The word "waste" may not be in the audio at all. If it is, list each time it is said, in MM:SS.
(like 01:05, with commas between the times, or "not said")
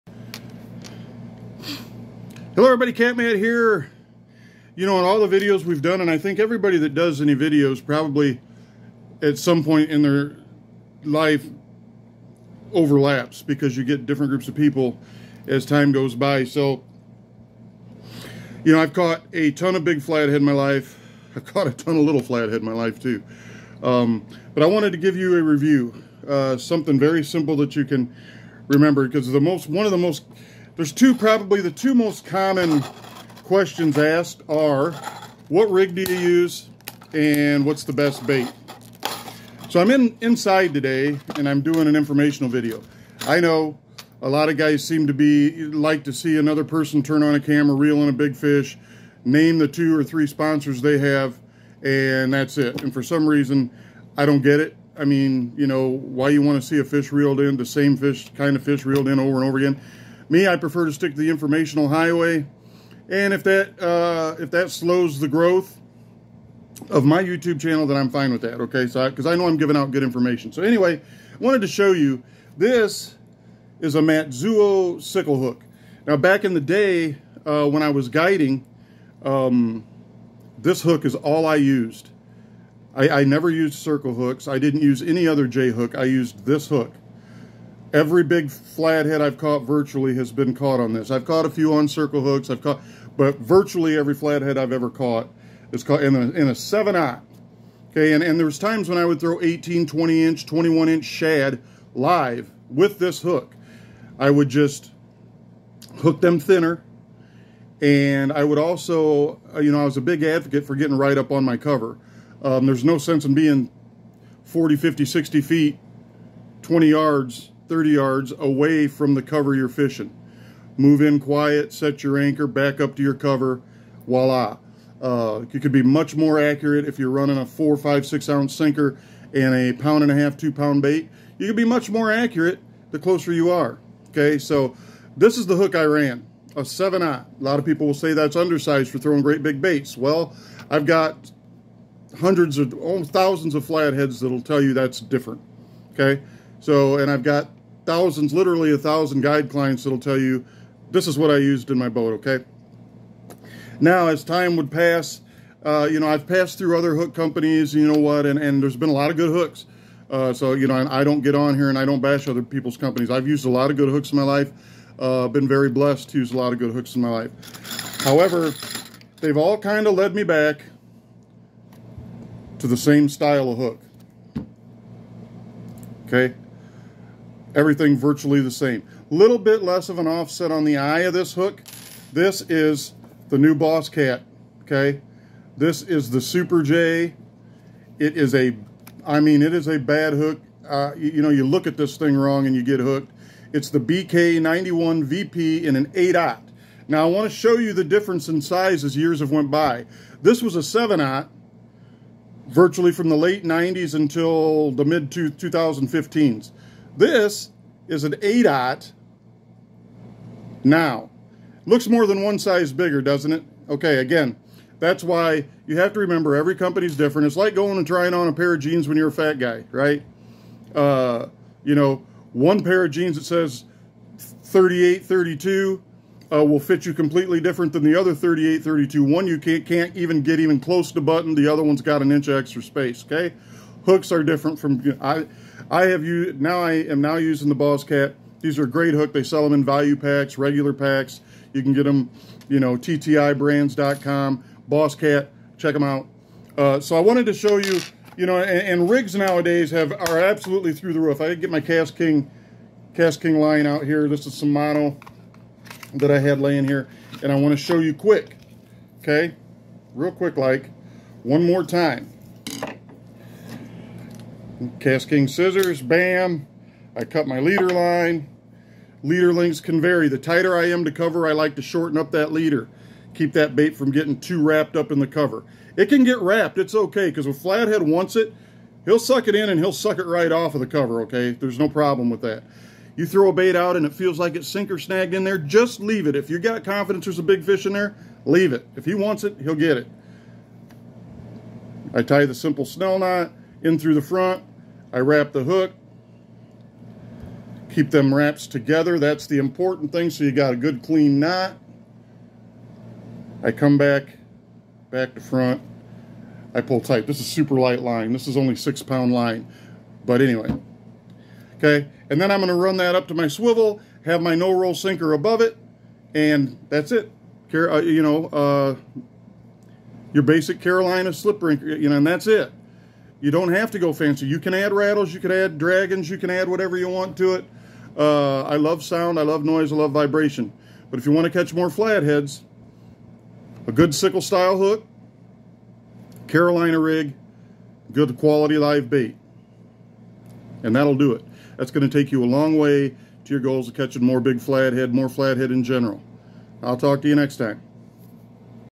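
not said.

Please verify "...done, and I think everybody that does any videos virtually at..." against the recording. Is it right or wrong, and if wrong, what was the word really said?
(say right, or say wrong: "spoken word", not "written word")
wrong: "probably", not "virtually".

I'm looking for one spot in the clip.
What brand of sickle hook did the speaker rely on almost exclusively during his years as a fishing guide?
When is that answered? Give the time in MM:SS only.
01:13.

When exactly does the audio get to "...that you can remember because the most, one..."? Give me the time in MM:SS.
00:27.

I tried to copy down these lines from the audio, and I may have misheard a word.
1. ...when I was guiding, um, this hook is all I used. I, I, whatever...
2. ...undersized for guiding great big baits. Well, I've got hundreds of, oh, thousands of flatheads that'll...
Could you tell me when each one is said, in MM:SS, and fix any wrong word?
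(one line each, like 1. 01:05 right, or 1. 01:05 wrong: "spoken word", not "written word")
1. 01:17 wrong: "never", not "whatever"
2. 02:18 wrong: "throwing", not "guiding".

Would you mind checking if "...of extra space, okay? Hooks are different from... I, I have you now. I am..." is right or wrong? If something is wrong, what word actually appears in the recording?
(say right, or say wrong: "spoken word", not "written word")
right.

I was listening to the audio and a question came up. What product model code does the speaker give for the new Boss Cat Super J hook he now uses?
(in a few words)
BK91 VP.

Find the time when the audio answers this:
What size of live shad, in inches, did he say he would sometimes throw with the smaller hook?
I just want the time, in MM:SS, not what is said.
01:40.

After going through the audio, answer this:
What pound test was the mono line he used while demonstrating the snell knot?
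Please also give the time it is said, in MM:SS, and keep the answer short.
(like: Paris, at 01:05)
6 pound, at 05:08.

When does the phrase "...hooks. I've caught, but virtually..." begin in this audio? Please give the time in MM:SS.
01:32.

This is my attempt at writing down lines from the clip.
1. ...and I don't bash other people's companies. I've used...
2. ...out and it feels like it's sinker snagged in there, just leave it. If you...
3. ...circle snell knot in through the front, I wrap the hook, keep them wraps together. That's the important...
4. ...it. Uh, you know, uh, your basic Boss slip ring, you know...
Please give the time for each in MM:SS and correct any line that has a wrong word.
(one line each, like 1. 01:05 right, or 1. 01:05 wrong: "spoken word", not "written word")
1. 02:41 right
2. 04:43 right
3. 04:52 wrong: "simple", not "circle"
4. 05:16 wrong: "Carolina", not "Boss".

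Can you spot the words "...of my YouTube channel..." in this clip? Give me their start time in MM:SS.
01:06.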